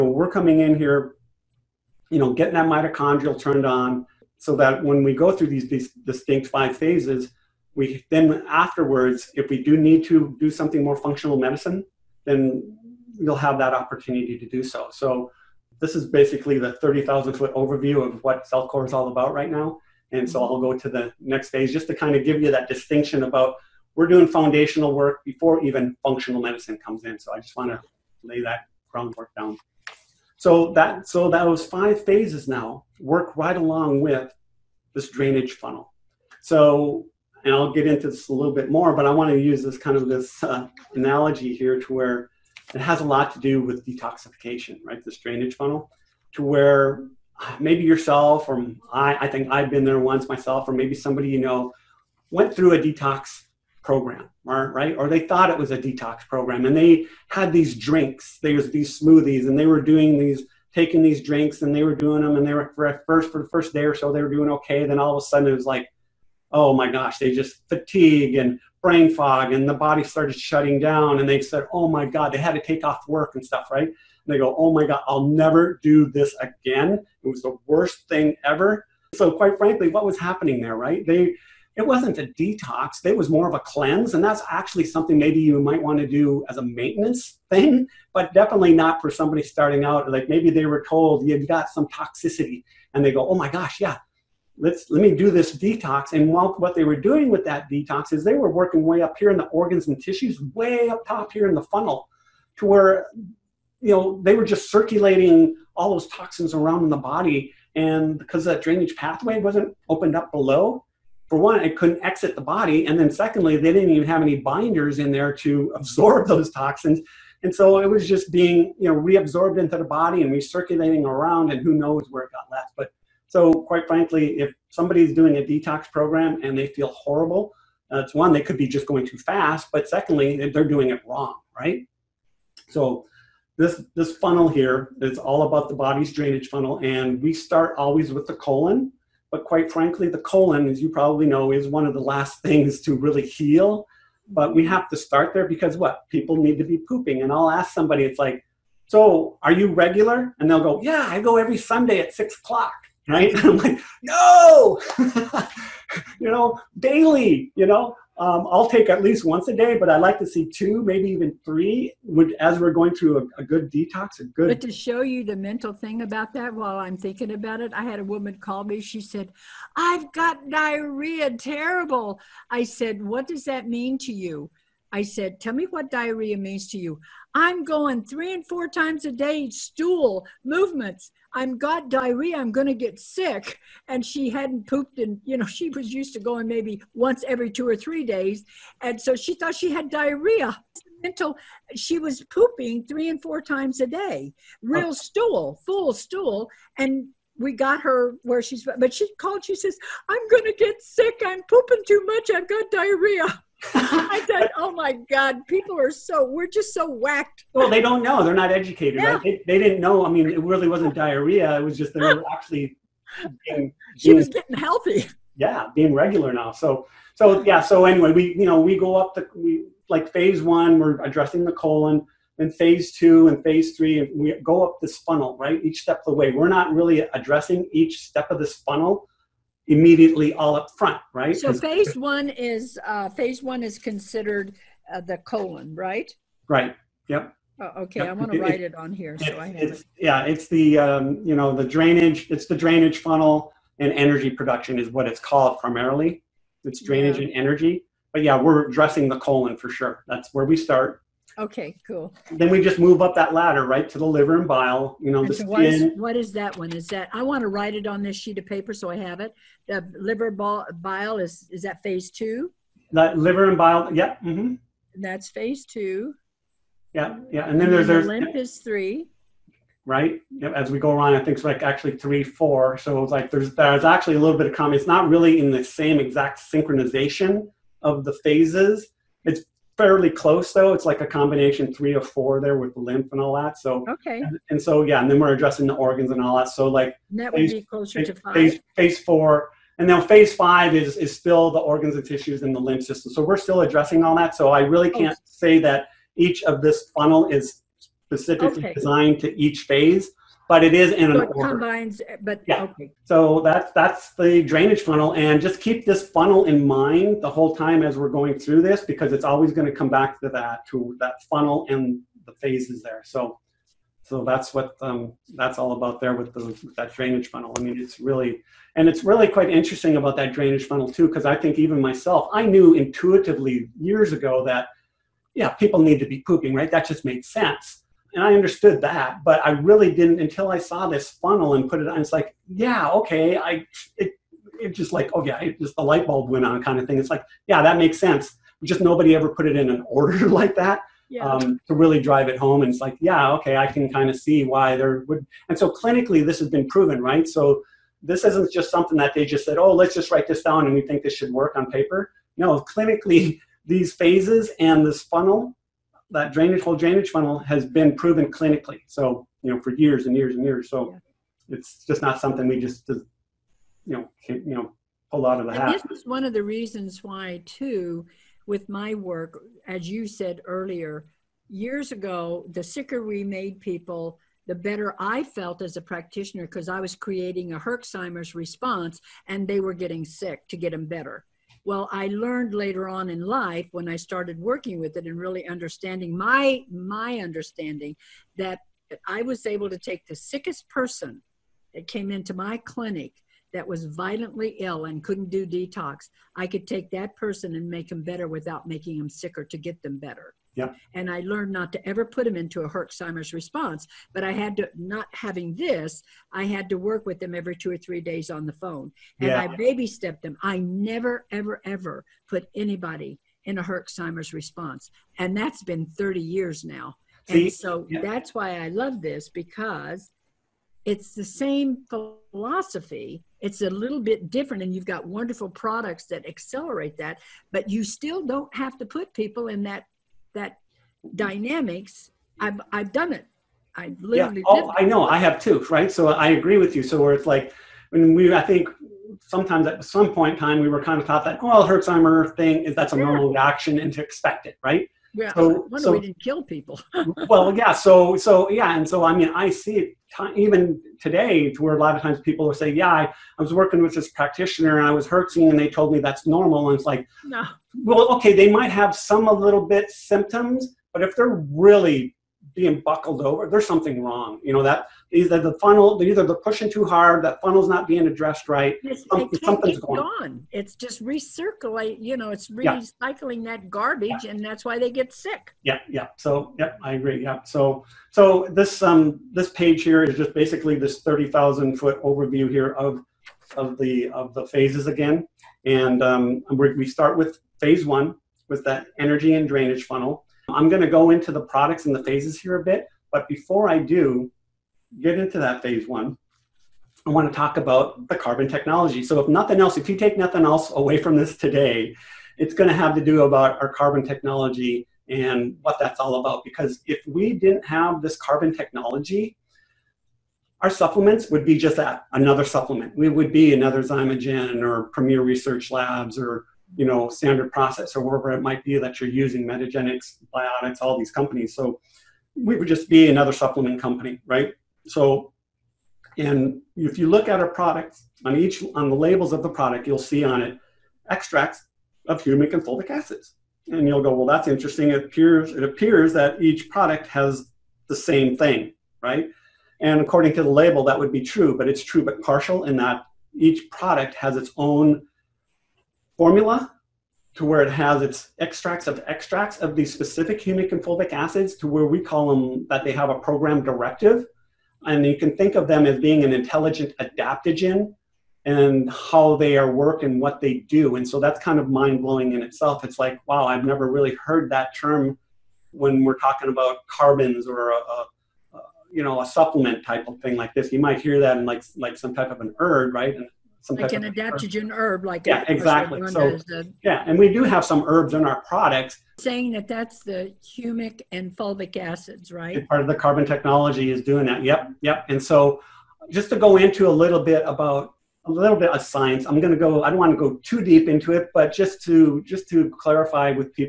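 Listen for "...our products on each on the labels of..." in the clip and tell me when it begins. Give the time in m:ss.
8:47.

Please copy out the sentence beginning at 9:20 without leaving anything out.
And so that's kind of mind blowing in itself.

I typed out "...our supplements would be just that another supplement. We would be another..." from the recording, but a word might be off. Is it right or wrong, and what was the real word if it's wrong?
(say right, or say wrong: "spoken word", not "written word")
right.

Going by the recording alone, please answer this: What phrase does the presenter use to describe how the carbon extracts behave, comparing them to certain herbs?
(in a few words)
intelligent adaptogen.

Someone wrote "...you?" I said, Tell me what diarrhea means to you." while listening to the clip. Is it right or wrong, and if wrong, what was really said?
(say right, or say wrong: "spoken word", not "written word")
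right.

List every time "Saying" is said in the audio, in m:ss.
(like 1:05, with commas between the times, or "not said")
9:39.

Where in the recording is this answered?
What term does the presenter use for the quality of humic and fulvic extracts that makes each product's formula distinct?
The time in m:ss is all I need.
9:13.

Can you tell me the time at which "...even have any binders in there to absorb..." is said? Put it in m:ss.
1:53.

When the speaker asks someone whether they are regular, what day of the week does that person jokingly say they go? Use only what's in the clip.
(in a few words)
Sunday.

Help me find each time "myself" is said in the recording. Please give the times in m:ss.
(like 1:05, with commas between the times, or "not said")
0:50, 5:21.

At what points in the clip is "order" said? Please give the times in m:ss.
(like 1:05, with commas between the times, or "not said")
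5:01, 5:39.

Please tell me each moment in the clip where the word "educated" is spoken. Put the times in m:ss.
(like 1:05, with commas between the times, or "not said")
3:28.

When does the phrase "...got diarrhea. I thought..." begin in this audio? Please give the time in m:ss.
3:22.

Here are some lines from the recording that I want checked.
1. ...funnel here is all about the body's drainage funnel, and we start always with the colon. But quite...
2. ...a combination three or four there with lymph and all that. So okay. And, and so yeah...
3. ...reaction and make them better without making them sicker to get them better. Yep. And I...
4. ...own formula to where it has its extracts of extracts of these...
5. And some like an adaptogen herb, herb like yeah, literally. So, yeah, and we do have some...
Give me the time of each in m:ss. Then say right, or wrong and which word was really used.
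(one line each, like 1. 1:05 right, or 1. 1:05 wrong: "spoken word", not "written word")
1. 2:14 right
2. 4:40 right
3. 6:37 wrong: "person", not "reaction"
4. 9:04 right
5. 9:33 wrong: "exactly", not "literally".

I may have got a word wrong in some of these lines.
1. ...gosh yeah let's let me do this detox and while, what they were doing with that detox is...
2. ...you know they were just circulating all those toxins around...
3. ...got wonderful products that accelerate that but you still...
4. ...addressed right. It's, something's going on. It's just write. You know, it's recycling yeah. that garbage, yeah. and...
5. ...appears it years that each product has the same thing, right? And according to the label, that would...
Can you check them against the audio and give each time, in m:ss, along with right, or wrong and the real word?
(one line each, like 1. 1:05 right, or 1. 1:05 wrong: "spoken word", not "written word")
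1. 1:33 right
2. 1:43 right
3. 7:04 right
4. 7:48 wrong: "recirculate", not "write"
5. 8:55 wrong: "appears", not "years".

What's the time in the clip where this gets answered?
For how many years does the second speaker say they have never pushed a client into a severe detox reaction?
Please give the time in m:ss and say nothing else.
6:55.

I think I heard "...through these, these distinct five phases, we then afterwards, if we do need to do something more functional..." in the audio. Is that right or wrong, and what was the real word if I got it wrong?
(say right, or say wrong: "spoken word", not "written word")
right.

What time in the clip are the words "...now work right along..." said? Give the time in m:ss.
0:32.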